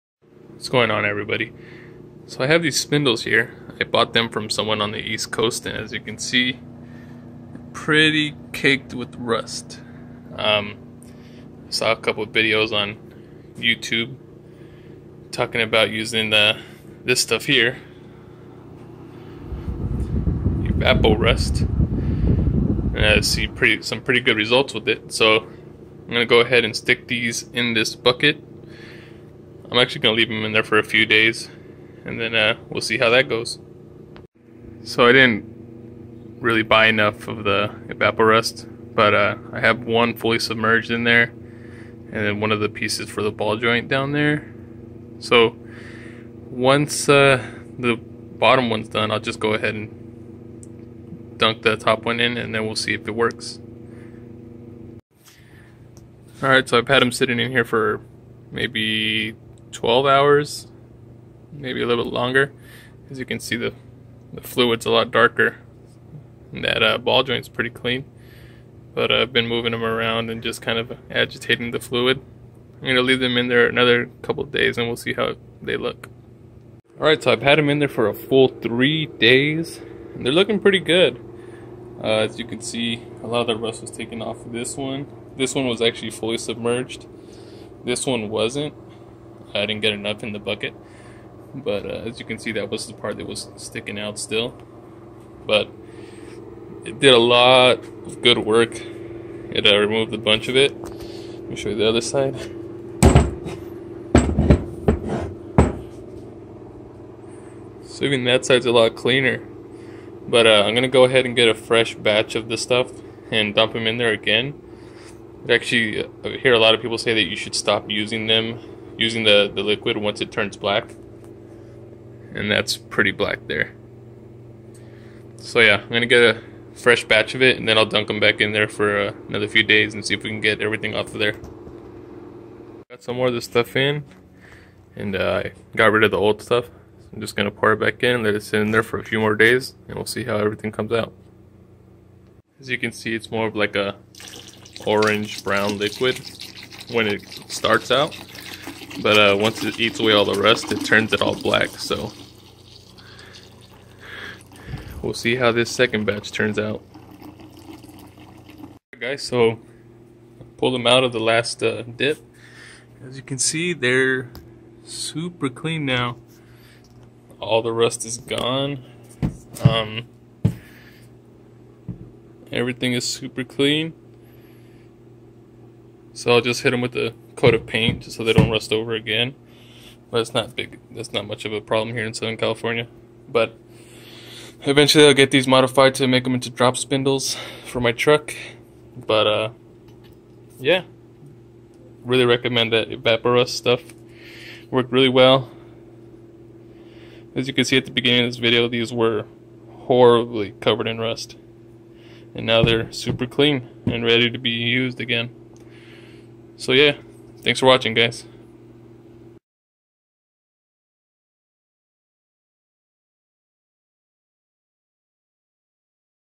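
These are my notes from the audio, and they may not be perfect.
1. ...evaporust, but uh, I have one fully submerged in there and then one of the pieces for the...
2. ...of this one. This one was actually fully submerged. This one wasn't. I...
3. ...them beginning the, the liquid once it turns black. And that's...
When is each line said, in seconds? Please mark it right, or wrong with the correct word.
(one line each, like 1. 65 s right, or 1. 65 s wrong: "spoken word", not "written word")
1. 37 s right
2. 84 s right
3. 118 s wrong: "using", not "beginning".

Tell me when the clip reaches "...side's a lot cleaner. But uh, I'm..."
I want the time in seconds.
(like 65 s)
108 s.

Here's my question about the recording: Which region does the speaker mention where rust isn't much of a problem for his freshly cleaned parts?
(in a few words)
Southern California.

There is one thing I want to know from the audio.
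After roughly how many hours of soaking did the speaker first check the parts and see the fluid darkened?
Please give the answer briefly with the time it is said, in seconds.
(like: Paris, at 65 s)
12, at 59 s.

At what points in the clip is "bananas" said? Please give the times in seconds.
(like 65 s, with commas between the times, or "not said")
not said.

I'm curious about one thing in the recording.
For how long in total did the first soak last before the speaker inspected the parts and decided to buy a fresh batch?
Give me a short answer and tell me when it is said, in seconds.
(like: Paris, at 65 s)
3 days, at 78 s.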